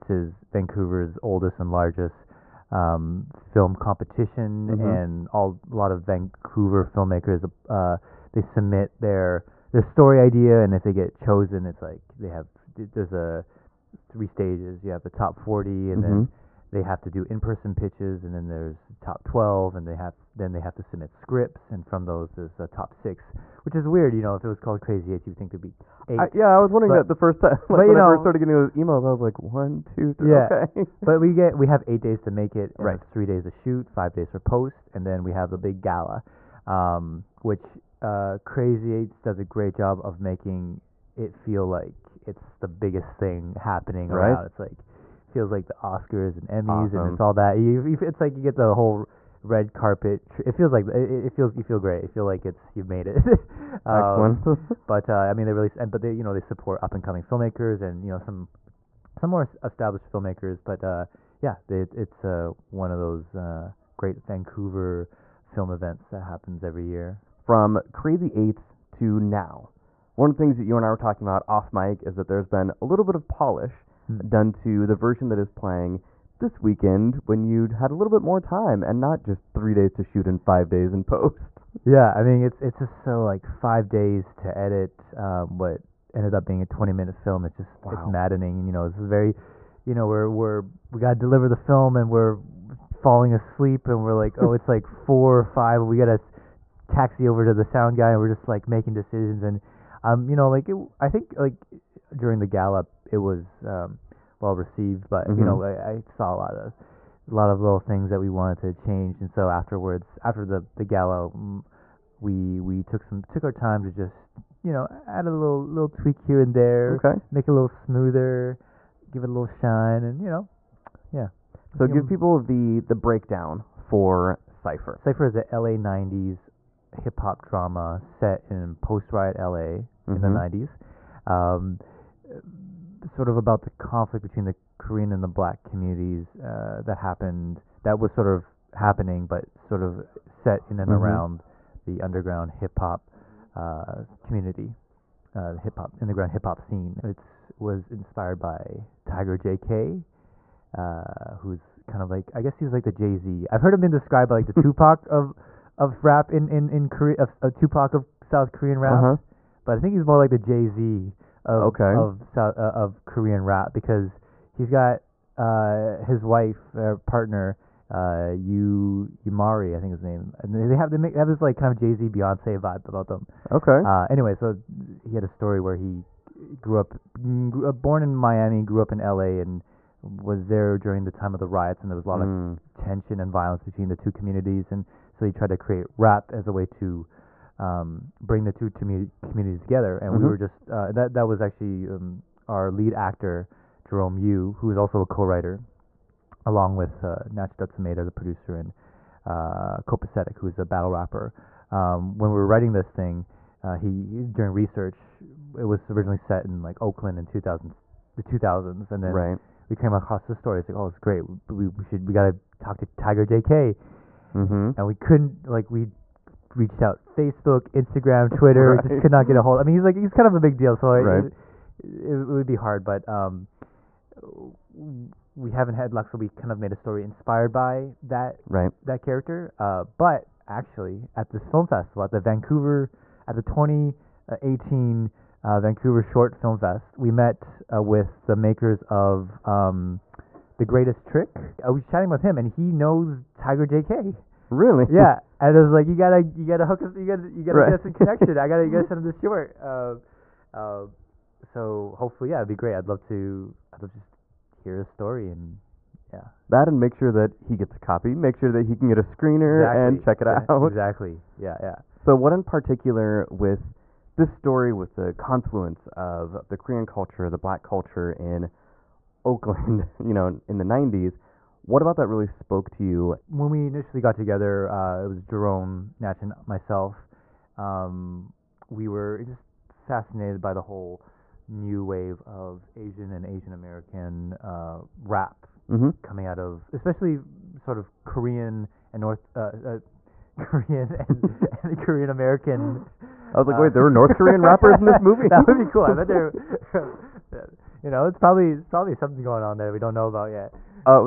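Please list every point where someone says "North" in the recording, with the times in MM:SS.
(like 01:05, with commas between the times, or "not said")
04:49, 04:53.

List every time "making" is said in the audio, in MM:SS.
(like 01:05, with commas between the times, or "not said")
00:40, 01:38.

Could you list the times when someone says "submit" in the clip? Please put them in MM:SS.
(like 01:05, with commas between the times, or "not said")
00:08, 00:20.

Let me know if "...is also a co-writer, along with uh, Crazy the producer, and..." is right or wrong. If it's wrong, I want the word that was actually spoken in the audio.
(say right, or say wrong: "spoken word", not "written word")
wrong: "Natch", not "Crazy".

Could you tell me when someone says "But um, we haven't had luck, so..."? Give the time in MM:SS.
03:42.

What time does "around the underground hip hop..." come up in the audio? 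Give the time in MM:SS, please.
02:21.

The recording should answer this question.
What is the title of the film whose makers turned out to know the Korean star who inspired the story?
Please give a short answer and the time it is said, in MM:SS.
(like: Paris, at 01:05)
The Greatest Trick, at 04:00.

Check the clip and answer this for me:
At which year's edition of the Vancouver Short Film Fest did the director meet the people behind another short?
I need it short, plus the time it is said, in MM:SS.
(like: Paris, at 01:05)
2018, at 03:53.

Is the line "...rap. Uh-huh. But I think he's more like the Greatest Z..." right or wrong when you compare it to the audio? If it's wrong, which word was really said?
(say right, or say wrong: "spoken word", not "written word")
wrong: "Jay", not "Greatest".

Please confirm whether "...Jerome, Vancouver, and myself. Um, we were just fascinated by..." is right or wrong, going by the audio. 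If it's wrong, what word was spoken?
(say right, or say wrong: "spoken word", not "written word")
wrong: "Natch", not "Vancouver".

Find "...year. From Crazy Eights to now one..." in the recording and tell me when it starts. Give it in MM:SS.
01:06.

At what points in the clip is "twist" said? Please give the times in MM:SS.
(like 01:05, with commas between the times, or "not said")
not said.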